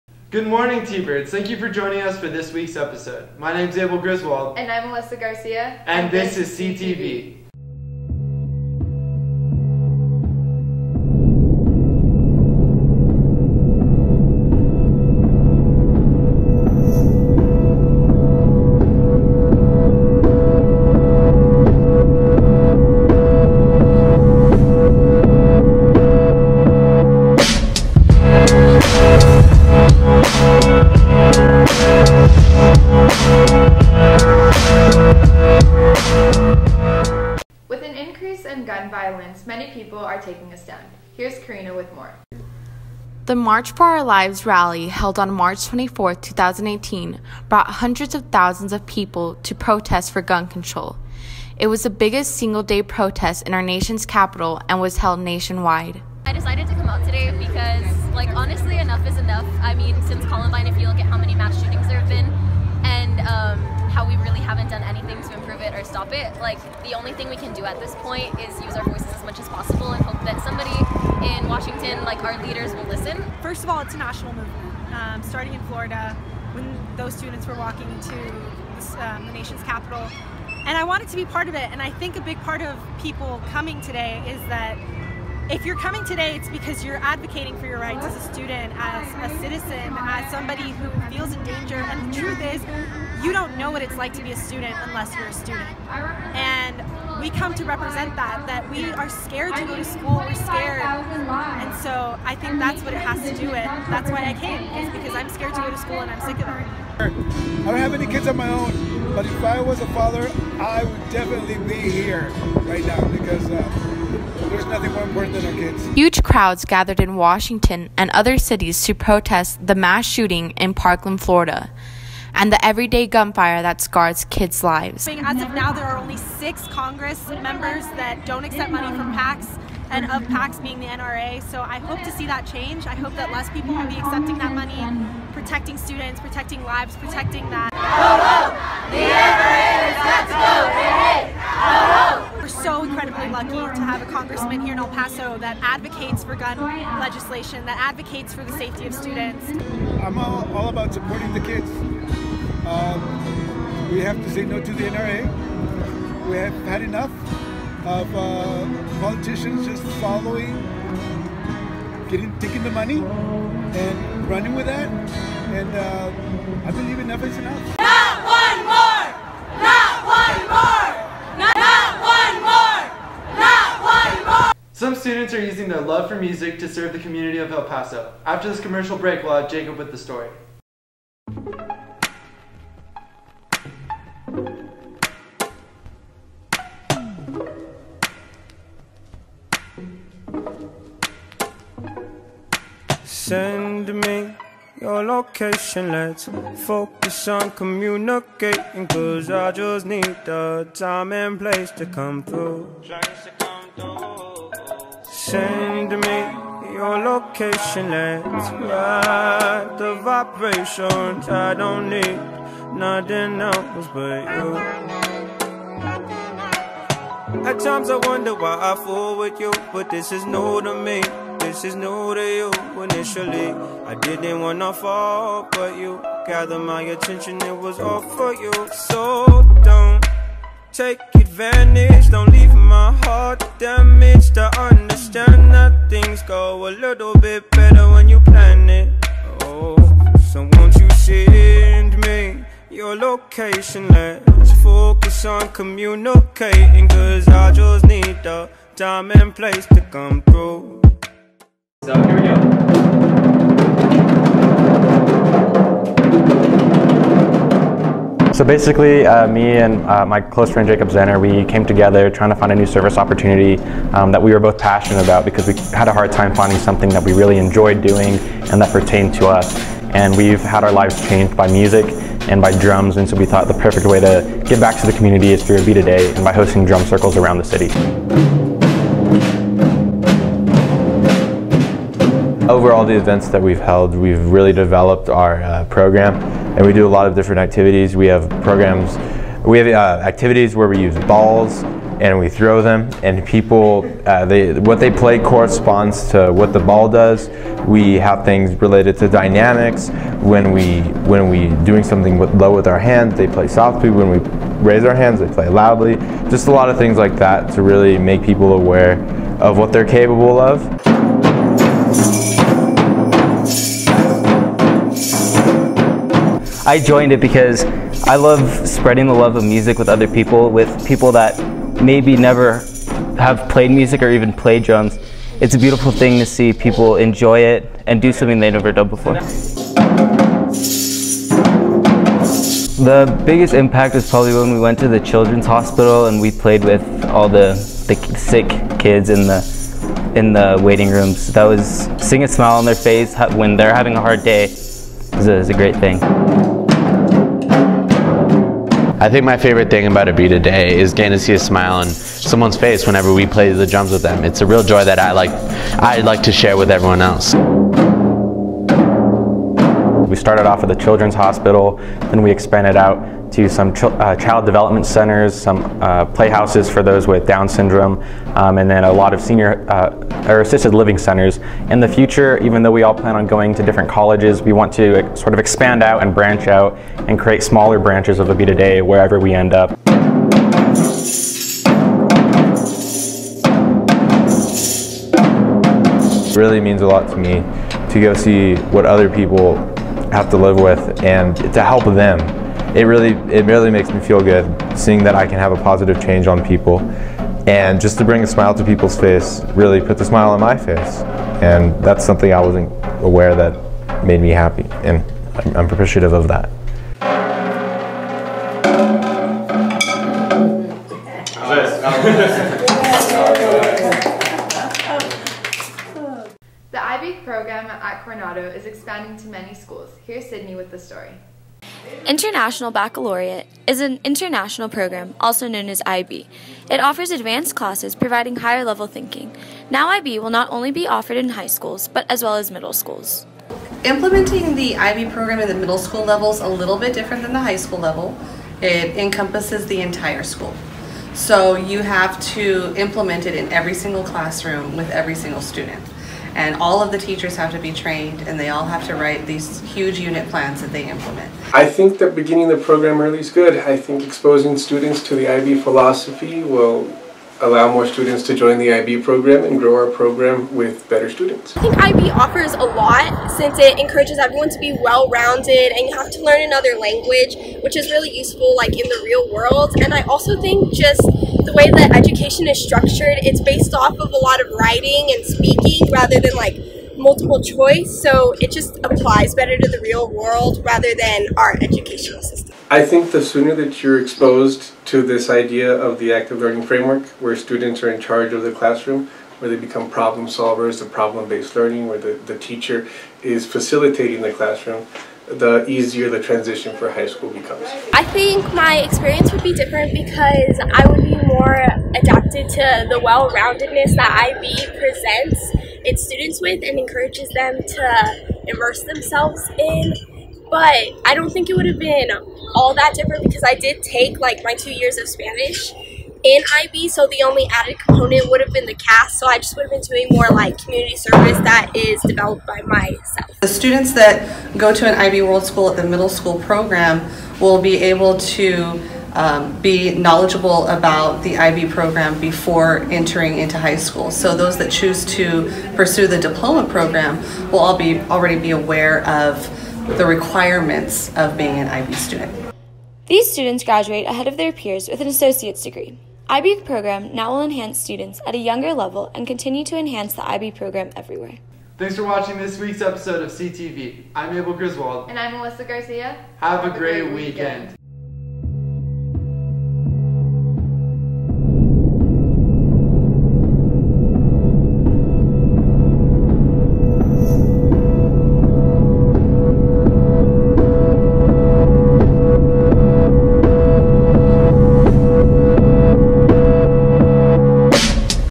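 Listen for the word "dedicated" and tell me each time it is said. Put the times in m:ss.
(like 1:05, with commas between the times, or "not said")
not said.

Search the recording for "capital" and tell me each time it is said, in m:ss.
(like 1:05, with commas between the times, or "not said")
0:54, 1:19.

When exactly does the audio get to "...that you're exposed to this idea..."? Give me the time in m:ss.
8:03.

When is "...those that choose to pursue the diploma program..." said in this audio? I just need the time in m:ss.
8:54.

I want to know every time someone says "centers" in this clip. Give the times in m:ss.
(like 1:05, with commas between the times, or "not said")
6:04, 6:10.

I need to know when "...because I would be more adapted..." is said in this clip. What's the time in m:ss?
8:19.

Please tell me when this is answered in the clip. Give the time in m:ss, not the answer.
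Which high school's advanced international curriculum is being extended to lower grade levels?
6:58.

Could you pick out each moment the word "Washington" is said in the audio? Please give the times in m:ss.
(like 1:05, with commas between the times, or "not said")
1:11, 1:57.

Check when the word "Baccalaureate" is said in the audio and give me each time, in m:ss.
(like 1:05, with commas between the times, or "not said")
7:02.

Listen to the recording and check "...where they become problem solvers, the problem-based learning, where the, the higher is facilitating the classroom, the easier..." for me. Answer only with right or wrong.
wrong.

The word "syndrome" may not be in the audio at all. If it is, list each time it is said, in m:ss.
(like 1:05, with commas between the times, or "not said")
6:07.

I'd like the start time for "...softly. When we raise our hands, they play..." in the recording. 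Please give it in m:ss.
5:03.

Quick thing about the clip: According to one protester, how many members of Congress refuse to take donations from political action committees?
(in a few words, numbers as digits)
6.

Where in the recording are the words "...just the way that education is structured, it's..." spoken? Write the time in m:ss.
7:50.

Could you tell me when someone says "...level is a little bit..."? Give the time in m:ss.
7:16.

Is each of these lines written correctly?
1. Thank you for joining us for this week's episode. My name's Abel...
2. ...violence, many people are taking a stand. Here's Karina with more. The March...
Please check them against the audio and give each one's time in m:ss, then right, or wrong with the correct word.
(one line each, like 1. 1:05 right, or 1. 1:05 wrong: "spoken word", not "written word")
1. 0:01 right
2. 0:38 right.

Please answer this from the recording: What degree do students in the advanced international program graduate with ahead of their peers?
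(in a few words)
Associate's degree.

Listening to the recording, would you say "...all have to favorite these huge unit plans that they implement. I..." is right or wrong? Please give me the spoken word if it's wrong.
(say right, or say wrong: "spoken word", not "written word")
wrong: "write", not "favorite".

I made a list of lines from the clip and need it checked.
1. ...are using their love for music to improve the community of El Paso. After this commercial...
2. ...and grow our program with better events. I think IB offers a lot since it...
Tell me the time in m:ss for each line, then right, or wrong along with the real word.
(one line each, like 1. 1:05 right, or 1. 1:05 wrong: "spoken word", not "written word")
1. 2:55 wrong: "serve", not "improve"
2. 7:39 wrong: "students", not "events".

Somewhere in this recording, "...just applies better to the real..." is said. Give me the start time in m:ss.
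7:58.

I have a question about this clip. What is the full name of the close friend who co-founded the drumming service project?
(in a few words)
Jacob Zenner.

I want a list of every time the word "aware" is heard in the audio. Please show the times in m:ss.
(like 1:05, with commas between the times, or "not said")
5:08, 6:43, 8:58.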